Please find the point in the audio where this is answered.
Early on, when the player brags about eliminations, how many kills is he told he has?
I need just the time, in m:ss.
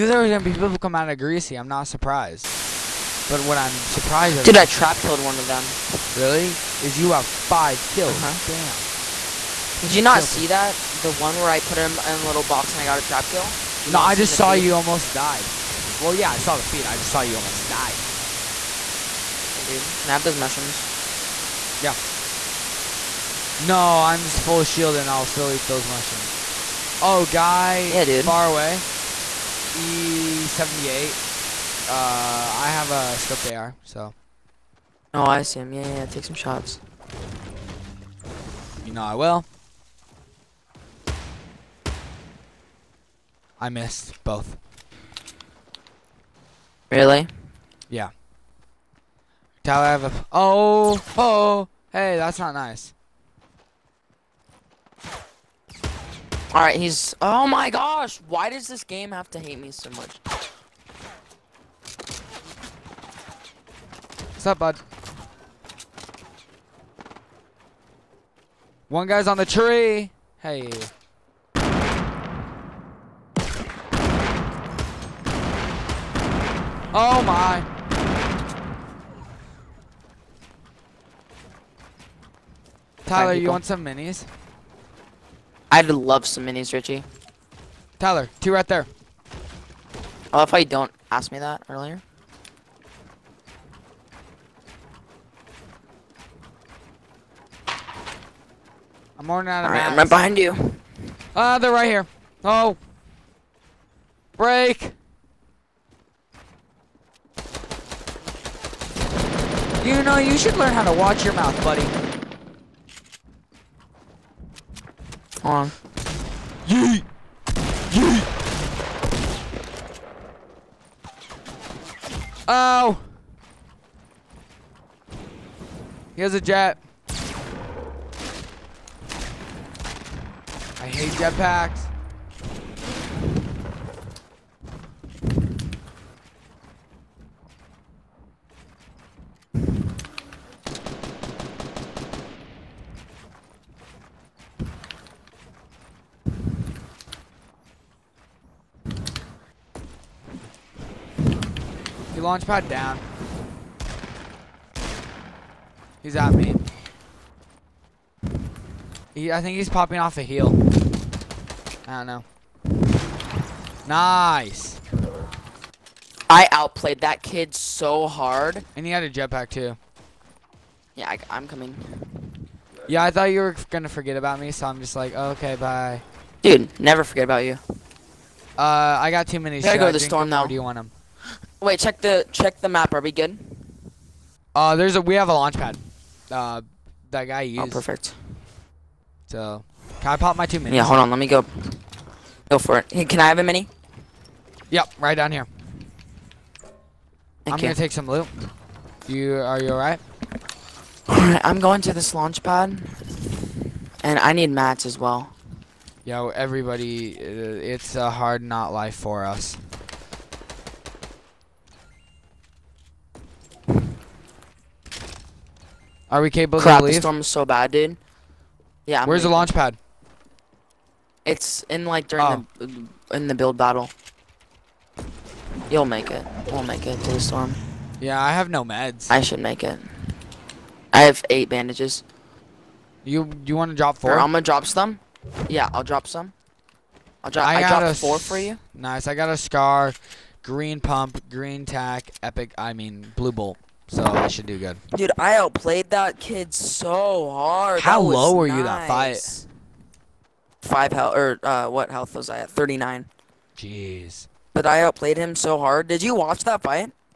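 0:07.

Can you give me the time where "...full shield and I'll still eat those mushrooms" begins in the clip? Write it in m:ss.
0:24.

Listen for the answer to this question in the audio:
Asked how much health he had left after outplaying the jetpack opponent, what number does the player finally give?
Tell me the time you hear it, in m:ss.
4:12.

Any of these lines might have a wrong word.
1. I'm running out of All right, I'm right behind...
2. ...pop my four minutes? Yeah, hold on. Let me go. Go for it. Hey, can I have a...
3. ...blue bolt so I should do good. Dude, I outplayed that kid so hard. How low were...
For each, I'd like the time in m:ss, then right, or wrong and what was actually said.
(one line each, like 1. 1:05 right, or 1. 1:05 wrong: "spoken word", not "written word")
1. 1:39 right
2. 3:10 wrong: "two", not "four"
3. 4:03 right.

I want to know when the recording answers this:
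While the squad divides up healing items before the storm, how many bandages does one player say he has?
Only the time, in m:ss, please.
3:51.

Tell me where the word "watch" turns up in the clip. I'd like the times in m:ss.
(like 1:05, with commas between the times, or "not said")
1:50, 4:16.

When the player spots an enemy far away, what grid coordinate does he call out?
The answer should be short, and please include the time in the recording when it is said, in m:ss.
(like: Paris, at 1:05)
E78, at 0:29.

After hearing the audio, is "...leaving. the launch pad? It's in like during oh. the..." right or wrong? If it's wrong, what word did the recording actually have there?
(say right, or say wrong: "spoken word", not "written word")
right.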